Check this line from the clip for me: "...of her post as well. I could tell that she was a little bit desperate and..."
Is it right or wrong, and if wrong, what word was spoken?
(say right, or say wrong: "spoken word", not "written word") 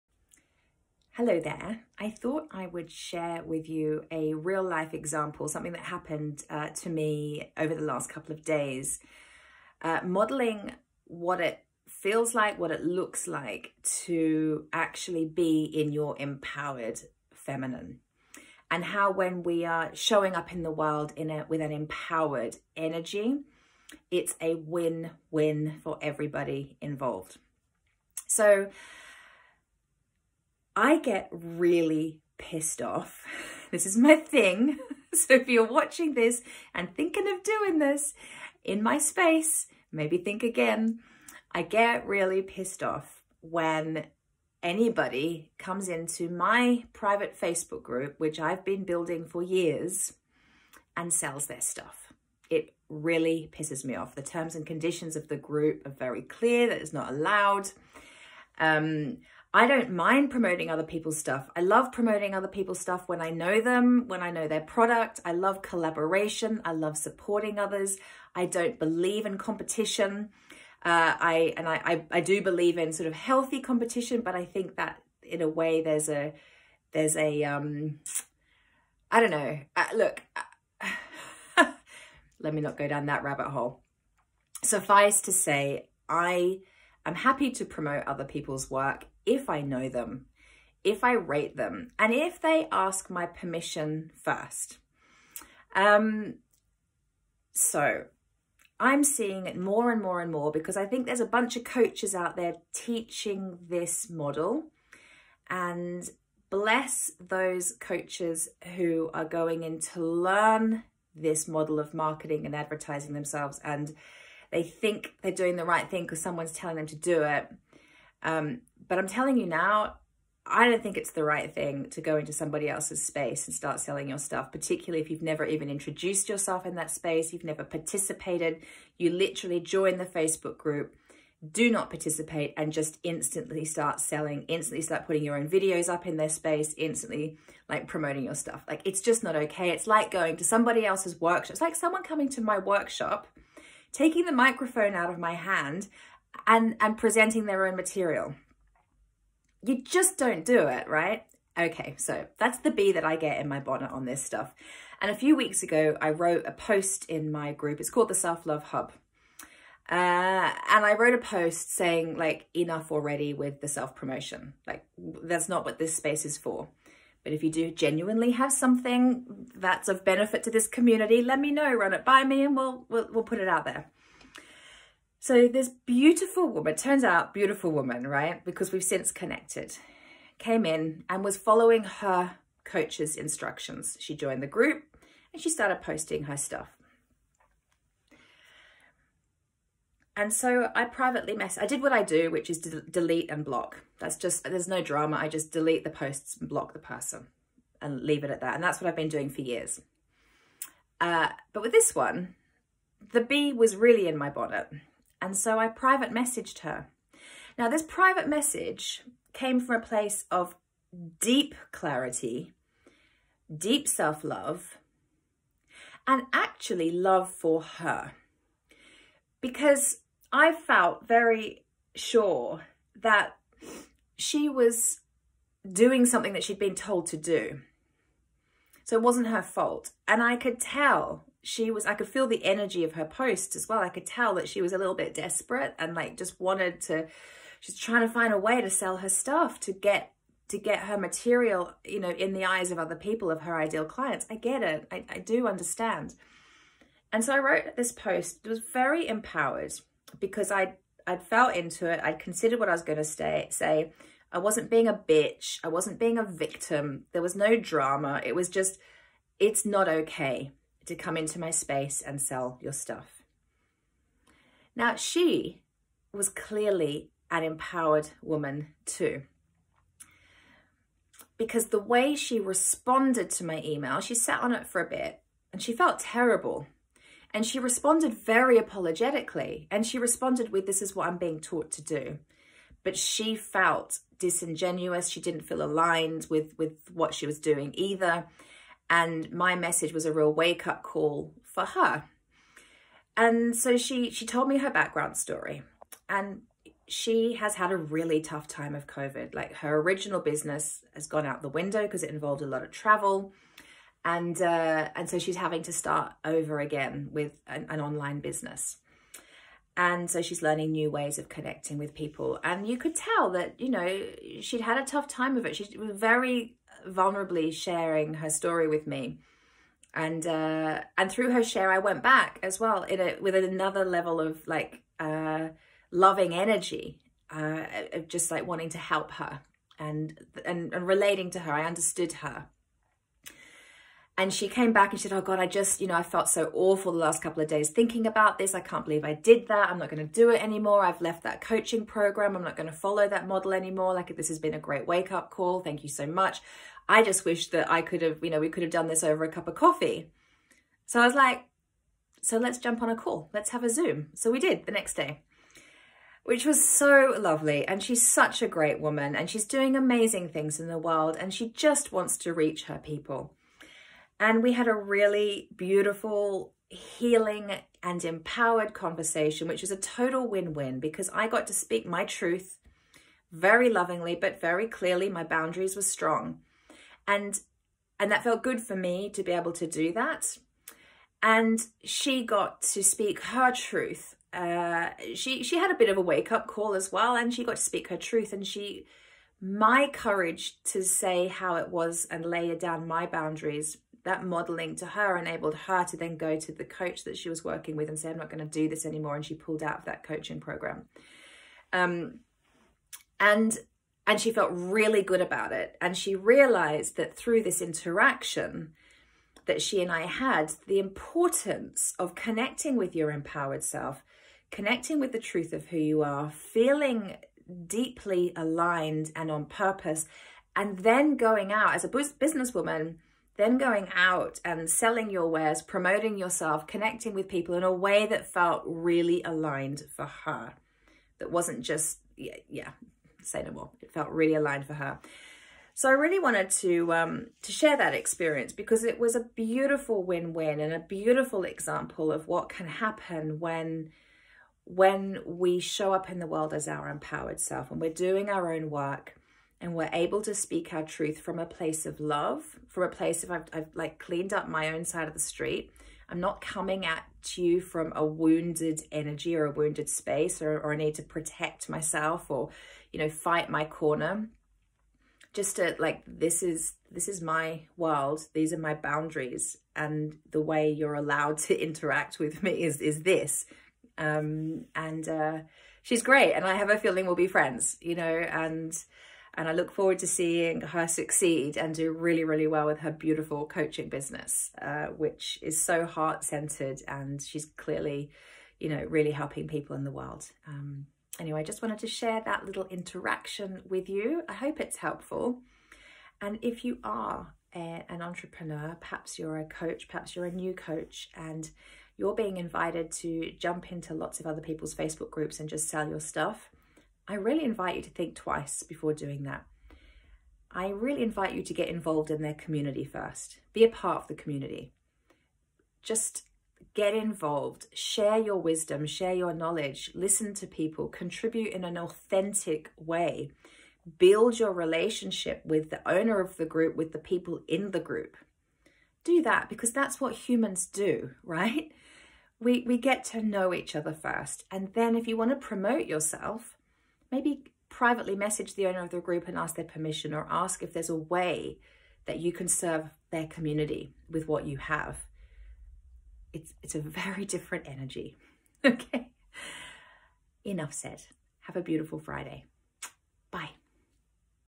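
right.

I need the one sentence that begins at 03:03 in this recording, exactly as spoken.
She joined the group and she started posting her stuff.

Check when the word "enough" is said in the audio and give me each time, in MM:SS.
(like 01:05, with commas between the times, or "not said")
02:42, 09:10.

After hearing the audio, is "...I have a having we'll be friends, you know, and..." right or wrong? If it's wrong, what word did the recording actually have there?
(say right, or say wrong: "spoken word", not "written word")
wrong: "feeling", not "having".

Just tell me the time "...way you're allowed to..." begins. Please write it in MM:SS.
07:50.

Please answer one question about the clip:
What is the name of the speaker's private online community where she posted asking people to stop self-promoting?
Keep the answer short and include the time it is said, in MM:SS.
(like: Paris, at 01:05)
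Self Love Hub, at 02:38.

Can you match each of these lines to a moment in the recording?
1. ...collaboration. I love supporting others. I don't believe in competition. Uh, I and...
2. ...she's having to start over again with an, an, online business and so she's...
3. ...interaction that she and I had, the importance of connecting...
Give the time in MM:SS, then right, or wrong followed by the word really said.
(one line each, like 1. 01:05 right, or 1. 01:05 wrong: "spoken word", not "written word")
1. 01:05 right
2. 05:05 right
3. 06:47 right.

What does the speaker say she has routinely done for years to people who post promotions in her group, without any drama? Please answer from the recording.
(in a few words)
delete and block.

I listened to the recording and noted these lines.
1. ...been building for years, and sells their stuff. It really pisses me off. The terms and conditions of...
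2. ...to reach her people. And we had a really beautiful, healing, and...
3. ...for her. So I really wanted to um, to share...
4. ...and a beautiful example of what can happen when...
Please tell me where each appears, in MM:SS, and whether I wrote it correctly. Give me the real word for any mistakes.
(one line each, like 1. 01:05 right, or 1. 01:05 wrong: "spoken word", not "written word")
1. 00:48 right
2. 06:02 right
3. 07:14 right
4. 07:20 right.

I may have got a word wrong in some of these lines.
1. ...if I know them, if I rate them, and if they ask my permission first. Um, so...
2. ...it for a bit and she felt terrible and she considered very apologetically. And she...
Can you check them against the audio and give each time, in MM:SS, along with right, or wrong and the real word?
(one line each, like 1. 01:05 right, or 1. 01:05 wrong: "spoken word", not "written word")
1. 01:29 right
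2. 04:34 wrong: "responded", not "considered".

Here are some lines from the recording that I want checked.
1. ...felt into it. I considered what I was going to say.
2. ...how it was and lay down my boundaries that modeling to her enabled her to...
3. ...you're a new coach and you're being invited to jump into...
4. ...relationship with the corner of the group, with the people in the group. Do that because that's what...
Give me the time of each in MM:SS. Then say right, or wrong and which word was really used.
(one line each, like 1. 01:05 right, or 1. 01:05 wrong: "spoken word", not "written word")
1. 04:11 right
2. 06:31 right
3. 08:20 right
4. 08:44 wrong: "owner", not "corner".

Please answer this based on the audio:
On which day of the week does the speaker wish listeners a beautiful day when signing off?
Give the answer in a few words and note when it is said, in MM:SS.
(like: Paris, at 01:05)
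Friday, at 09:11.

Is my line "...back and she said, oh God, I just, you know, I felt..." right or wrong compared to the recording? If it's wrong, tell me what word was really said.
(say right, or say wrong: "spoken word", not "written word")
right.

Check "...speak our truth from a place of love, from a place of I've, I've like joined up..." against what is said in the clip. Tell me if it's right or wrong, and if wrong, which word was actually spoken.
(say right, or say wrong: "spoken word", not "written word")
wrong: "cleaned", not "joined".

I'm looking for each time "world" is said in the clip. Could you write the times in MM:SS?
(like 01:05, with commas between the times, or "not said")
00:20, 06:00, 07:26, 07:47, 08:09.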